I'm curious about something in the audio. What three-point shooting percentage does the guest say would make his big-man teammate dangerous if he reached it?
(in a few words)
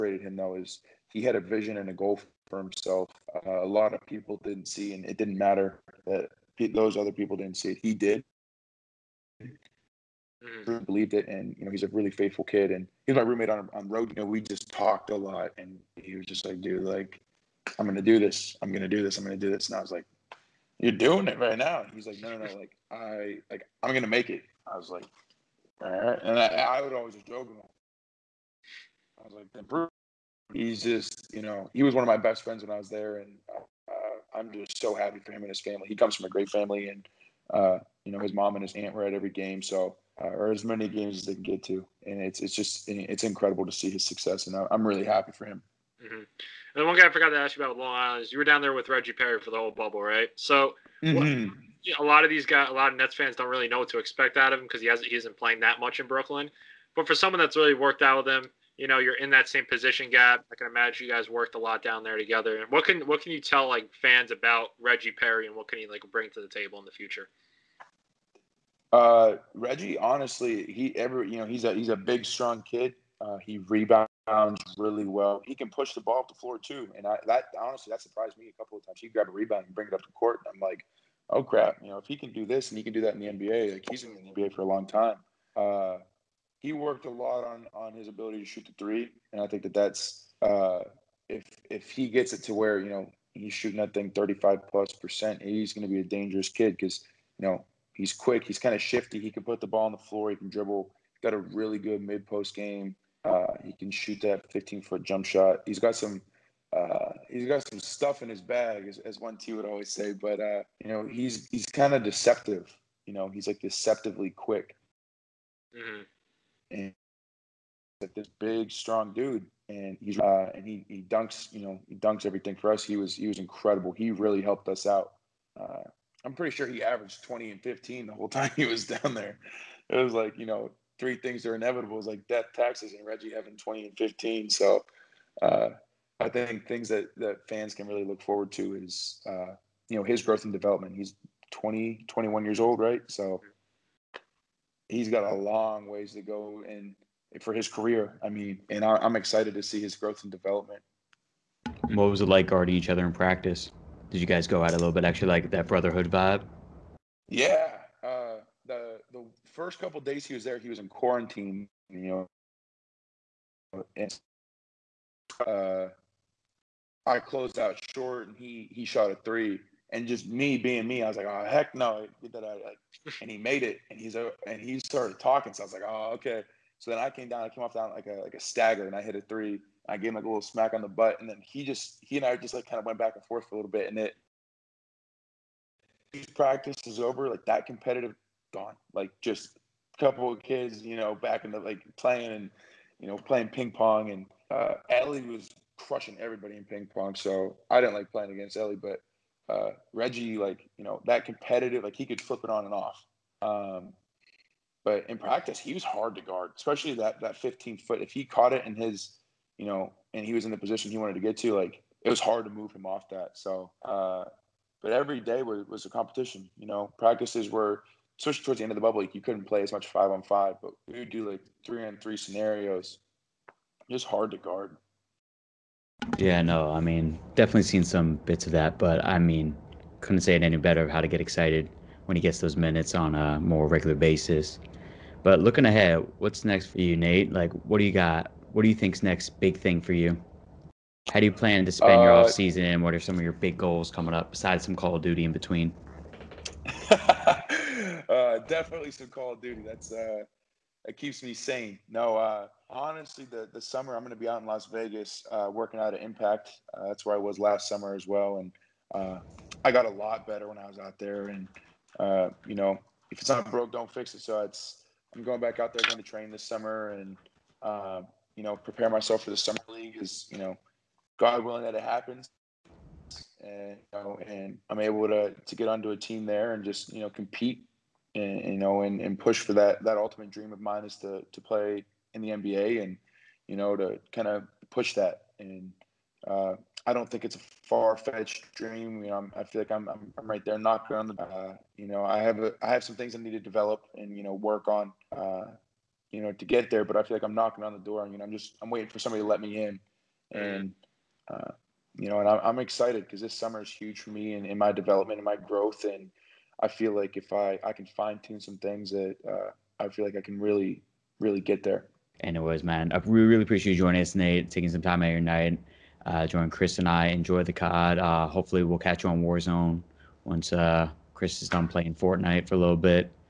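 35 percent.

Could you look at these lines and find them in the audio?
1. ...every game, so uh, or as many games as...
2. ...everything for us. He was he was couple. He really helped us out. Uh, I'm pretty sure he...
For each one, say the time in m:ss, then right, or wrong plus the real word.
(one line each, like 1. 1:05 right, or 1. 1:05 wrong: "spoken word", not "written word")
1. 0:39 right
2. 2:02 wrong: "incredible", not "couple".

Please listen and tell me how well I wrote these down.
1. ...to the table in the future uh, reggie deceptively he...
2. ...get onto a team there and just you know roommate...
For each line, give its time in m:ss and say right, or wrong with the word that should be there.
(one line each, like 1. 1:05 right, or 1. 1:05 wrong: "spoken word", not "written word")
1. 1:06 wrong: "honestly", not "deceptively"
2. 4:35 wrong: "compete", not "roommate".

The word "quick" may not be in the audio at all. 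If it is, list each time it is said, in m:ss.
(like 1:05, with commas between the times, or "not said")
1:38, 1:54.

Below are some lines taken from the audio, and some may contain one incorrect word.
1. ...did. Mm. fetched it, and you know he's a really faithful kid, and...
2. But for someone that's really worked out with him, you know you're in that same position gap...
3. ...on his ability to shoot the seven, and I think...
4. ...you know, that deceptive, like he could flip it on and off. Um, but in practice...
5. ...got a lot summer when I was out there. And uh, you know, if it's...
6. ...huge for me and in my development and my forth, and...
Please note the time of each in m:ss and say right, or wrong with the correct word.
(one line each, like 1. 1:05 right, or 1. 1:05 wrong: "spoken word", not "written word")
1. 0:07 wrong: "believed", not "fetched"
2. 0:56 right
3. 1:27 wrong: "three", not "seven"
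4. 3:20 wrong: "competitive", not "deceptive"
5. 4:19 wrong: "better", not "summer"
6. 5:03 wrong: "growth", not "forth".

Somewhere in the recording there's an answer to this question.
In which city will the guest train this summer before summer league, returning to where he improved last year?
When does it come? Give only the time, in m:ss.
4:14.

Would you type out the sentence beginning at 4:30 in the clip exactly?
Is you know, God willing that it happens.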